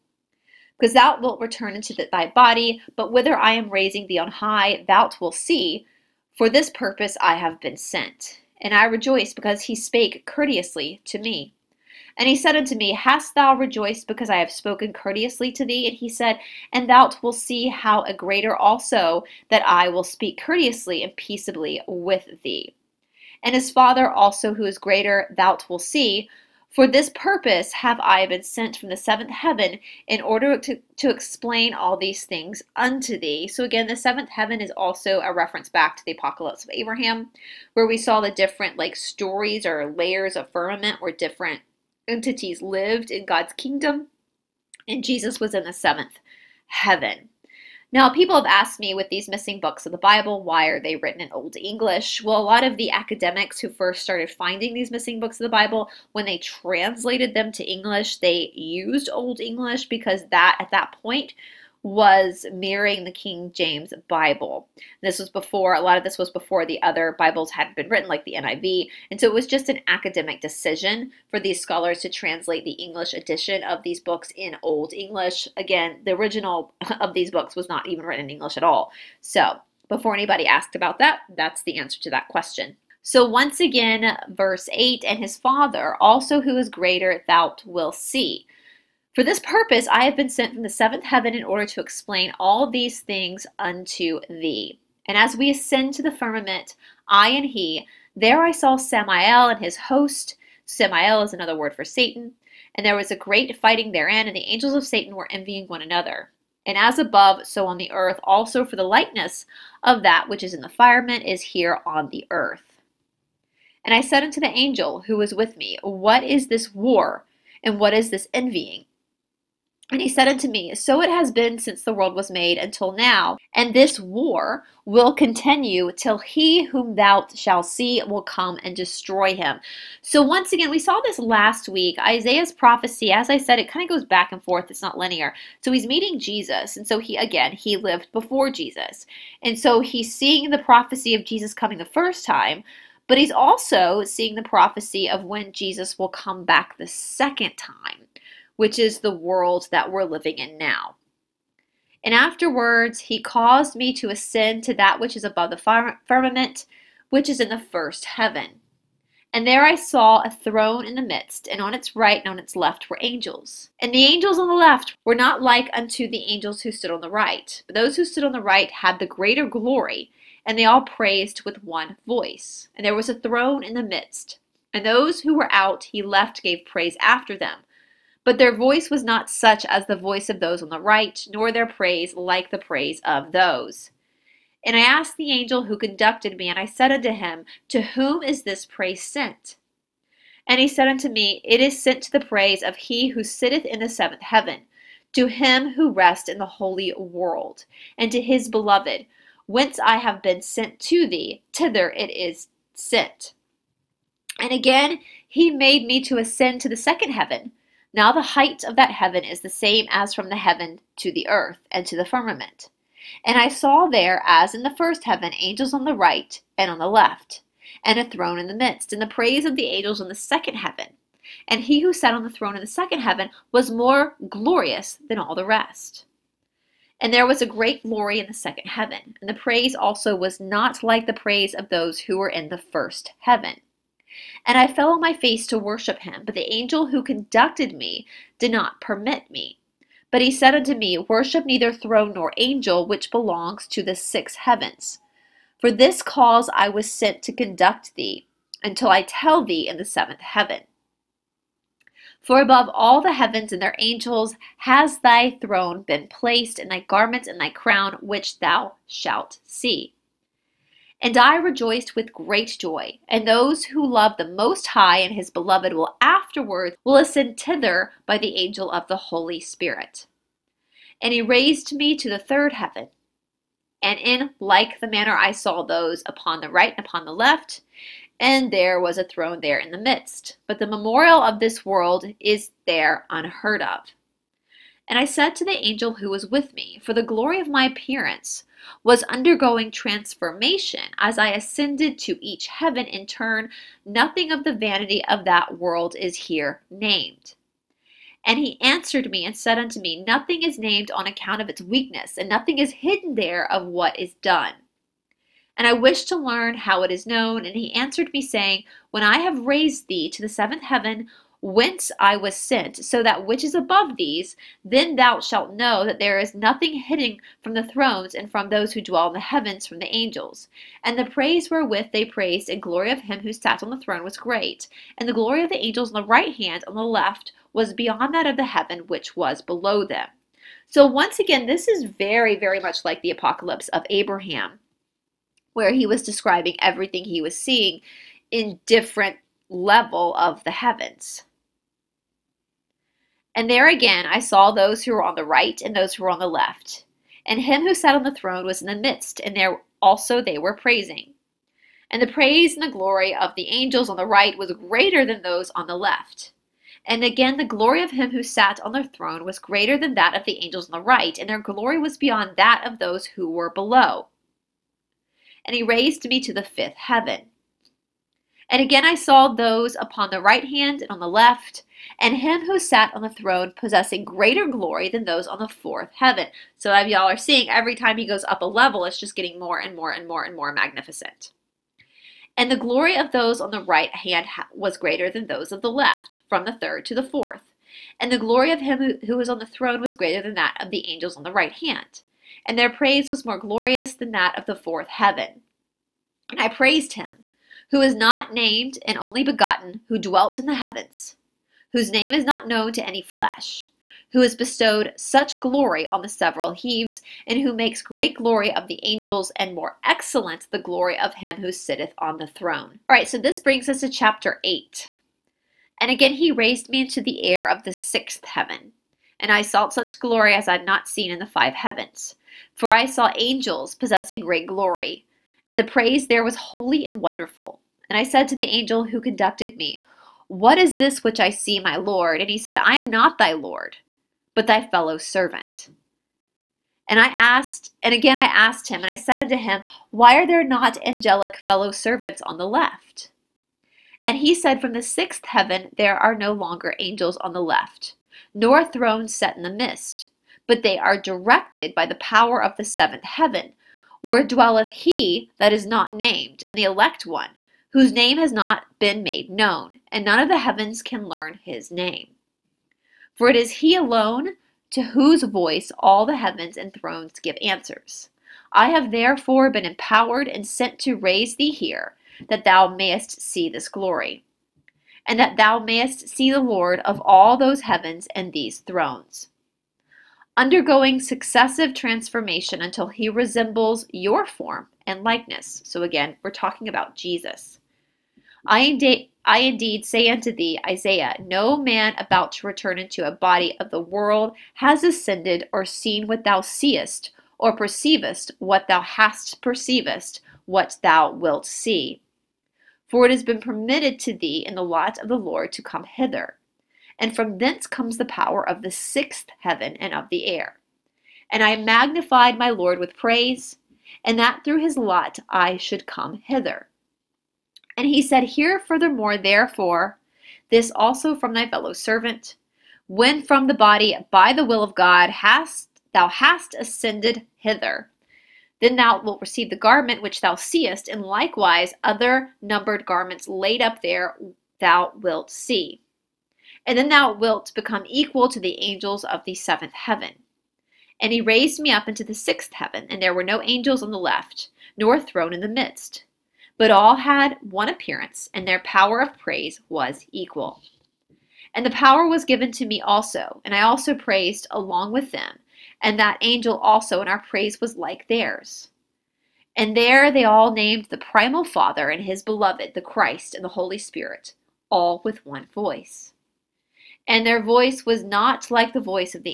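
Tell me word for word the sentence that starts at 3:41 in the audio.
And he who sat on the throne in the second heaven was more glorious than all the rest.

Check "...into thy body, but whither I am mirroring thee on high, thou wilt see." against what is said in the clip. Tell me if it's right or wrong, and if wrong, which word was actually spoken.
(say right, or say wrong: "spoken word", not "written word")
wrong: "raising", not "mirroring".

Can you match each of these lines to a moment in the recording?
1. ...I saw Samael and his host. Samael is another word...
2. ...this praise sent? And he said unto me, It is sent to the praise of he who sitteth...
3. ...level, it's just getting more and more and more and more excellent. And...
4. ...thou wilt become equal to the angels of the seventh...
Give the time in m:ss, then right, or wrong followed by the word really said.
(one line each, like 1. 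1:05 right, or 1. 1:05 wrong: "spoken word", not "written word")
1. 1:38 right
2. 3:08 right
3. 6:18 wrong: "magnificent", not "excellent"
4. 8:56 right.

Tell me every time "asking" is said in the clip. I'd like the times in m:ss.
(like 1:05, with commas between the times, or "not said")
not said.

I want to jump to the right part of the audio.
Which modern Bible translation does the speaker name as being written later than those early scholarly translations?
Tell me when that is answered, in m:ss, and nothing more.
1:08.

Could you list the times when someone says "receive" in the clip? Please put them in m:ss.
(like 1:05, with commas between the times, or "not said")
8:49.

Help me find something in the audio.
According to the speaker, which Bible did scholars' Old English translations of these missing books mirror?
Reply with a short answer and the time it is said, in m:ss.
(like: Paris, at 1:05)
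King James Bible, at 1:03.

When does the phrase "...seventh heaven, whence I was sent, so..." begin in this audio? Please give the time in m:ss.
5:10.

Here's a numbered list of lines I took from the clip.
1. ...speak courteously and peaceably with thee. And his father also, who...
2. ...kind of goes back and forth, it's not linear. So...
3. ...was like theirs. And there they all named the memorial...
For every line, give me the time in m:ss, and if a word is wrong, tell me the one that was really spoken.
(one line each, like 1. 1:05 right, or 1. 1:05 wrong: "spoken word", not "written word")
1. 0:20 right
2. 2:13 right
3. 9:17 wrong: "primal", not "memorial".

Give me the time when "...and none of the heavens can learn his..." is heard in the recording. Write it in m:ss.
7:39.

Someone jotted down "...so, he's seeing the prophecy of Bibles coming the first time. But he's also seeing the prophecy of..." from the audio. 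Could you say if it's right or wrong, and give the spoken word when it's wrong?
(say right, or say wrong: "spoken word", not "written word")
wrong: "Jesus", not "Bibles".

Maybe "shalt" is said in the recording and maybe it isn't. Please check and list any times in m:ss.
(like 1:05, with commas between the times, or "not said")
2:07, 4:18, 5:15.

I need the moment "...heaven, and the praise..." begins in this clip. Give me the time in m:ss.
3:48.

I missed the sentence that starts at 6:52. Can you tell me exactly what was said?
All right, so this brings us to chapter 8.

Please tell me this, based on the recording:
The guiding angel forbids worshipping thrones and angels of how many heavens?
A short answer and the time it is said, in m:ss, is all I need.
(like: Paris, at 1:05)
6, at 4:03.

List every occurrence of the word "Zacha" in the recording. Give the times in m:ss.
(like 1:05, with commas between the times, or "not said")
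not said.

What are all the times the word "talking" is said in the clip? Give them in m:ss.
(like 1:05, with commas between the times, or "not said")
8:06.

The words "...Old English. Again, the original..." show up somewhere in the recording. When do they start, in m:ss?
1:14.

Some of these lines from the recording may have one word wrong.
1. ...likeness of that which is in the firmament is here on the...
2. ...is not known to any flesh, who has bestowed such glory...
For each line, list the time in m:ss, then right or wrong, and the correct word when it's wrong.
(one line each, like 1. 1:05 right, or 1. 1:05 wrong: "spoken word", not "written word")
1. 1:48 right
2. 6:42 right.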